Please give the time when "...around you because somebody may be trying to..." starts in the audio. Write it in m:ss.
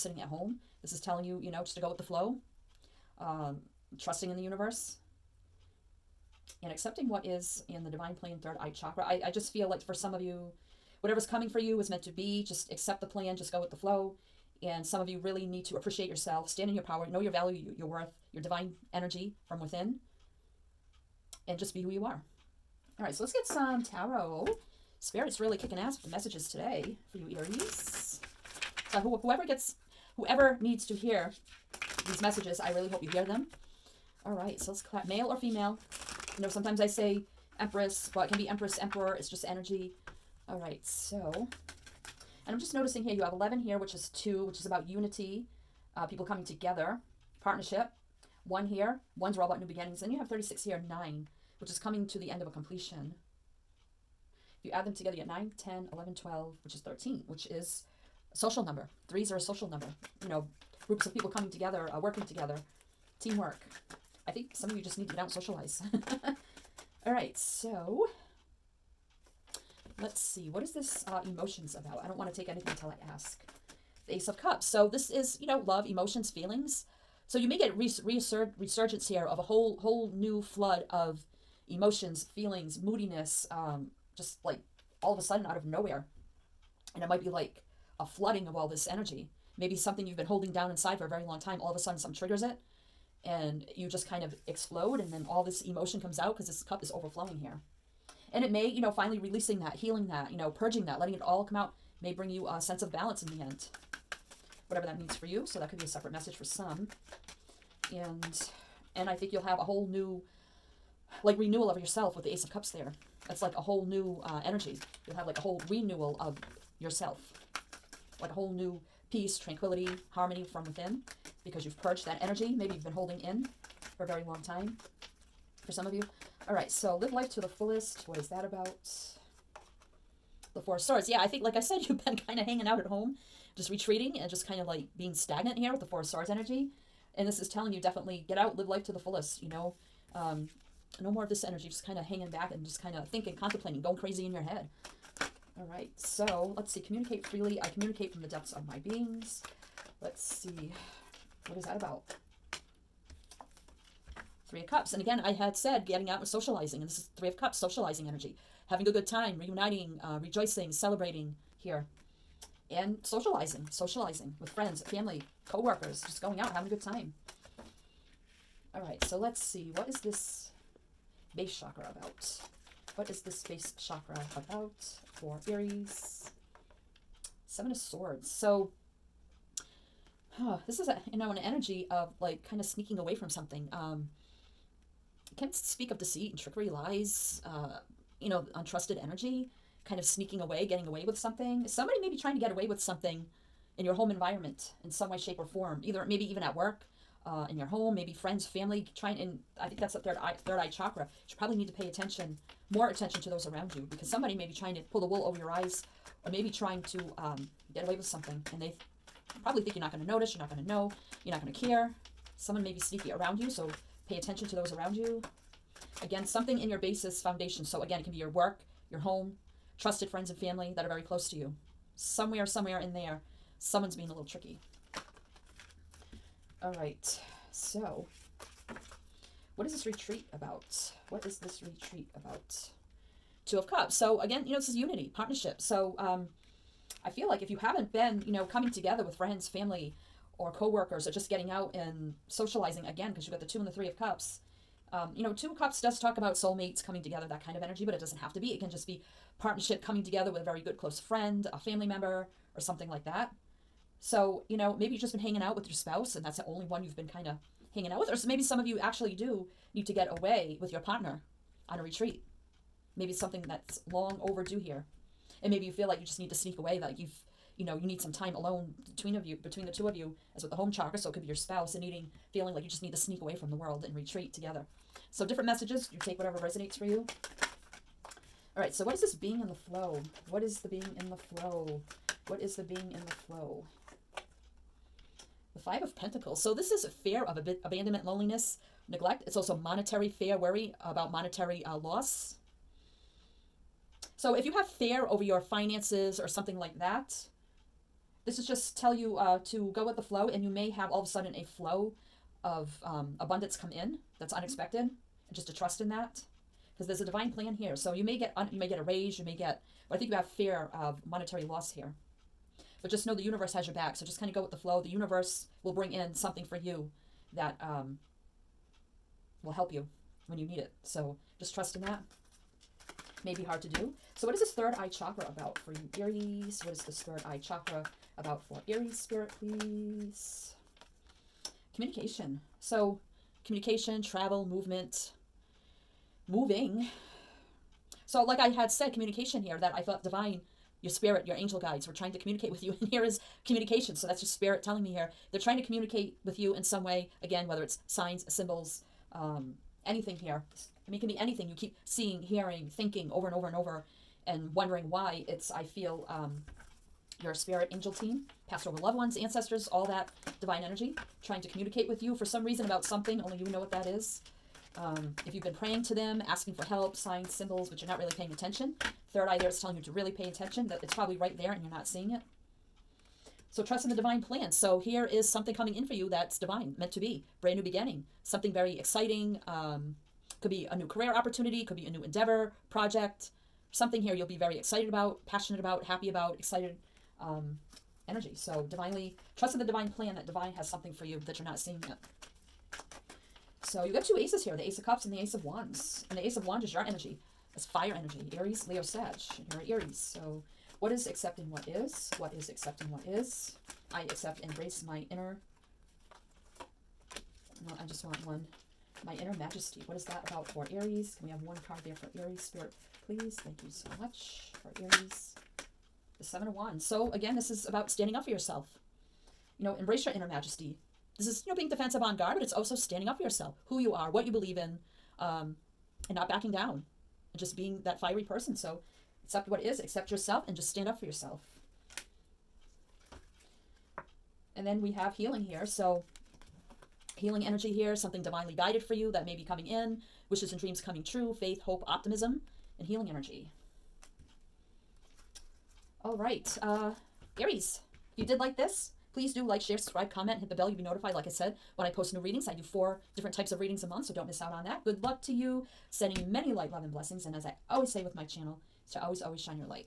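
3:23.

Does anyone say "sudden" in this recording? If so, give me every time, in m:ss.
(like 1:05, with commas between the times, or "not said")
1:25, 1:31, 5:01.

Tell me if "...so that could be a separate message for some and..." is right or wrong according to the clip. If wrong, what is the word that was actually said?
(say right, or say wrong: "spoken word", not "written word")
right.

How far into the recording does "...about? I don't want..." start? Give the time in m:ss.
1:11.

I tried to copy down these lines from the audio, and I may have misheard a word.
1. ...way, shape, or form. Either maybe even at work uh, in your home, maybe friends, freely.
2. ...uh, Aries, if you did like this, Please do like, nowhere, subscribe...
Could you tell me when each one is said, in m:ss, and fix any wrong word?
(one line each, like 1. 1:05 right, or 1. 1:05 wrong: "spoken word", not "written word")
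1. 3:15 wrong: "family", not "freely"
2. 7:26 wrong: "share", not "nowhere".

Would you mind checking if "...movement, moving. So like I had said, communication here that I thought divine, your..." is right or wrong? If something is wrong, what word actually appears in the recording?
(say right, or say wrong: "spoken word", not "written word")
right.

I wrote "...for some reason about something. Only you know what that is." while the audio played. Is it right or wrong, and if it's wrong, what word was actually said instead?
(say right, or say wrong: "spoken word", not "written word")
right.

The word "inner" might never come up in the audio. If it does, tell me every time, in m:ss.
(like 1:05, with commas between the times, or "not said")
6:45, 6:49, 7:00.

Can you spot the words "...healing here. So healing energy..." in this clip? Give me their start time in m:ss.
7:15.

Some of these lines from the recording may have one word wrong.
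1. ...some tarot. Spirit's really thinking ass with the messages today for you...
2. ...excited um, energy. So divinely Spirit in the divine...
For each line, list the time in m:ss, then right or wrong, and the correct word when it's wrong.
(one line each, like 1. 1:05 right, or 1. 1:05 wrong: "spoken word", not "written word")
1. 0:23 wrong: "kicking", not "thinking"
2. 6:26 wrong: "Trust", not "Spirit".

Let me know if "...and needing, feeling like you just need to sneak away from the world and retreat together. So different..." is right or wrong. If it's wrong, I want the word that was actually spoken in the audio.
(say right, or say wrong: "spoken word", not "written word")
right.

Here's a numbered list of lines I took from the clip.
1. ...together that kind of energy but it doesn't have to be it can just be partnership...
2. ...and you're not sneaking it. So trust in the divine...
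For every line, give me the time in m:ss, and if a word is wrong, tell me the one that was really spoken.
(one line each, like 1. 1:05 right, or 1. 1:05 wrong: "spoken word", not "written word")
1. 4:07 right
2. 6:11 wrong: "seeing", not "sneaking".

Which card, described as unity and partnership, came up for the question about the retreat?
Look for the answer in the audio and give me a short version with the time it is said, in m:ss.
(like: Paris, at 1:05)
Two of Cups, at 3:53.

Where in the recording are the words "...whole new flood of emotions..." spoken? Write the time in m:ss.
1:19.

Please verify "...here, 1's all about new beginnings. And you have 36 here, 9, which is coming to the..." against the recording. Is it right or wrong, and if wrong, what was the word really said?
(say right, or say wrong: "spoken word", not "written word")
right.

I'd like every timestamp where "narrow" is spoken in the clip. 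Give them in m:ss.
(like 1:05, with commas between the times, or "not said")
not said.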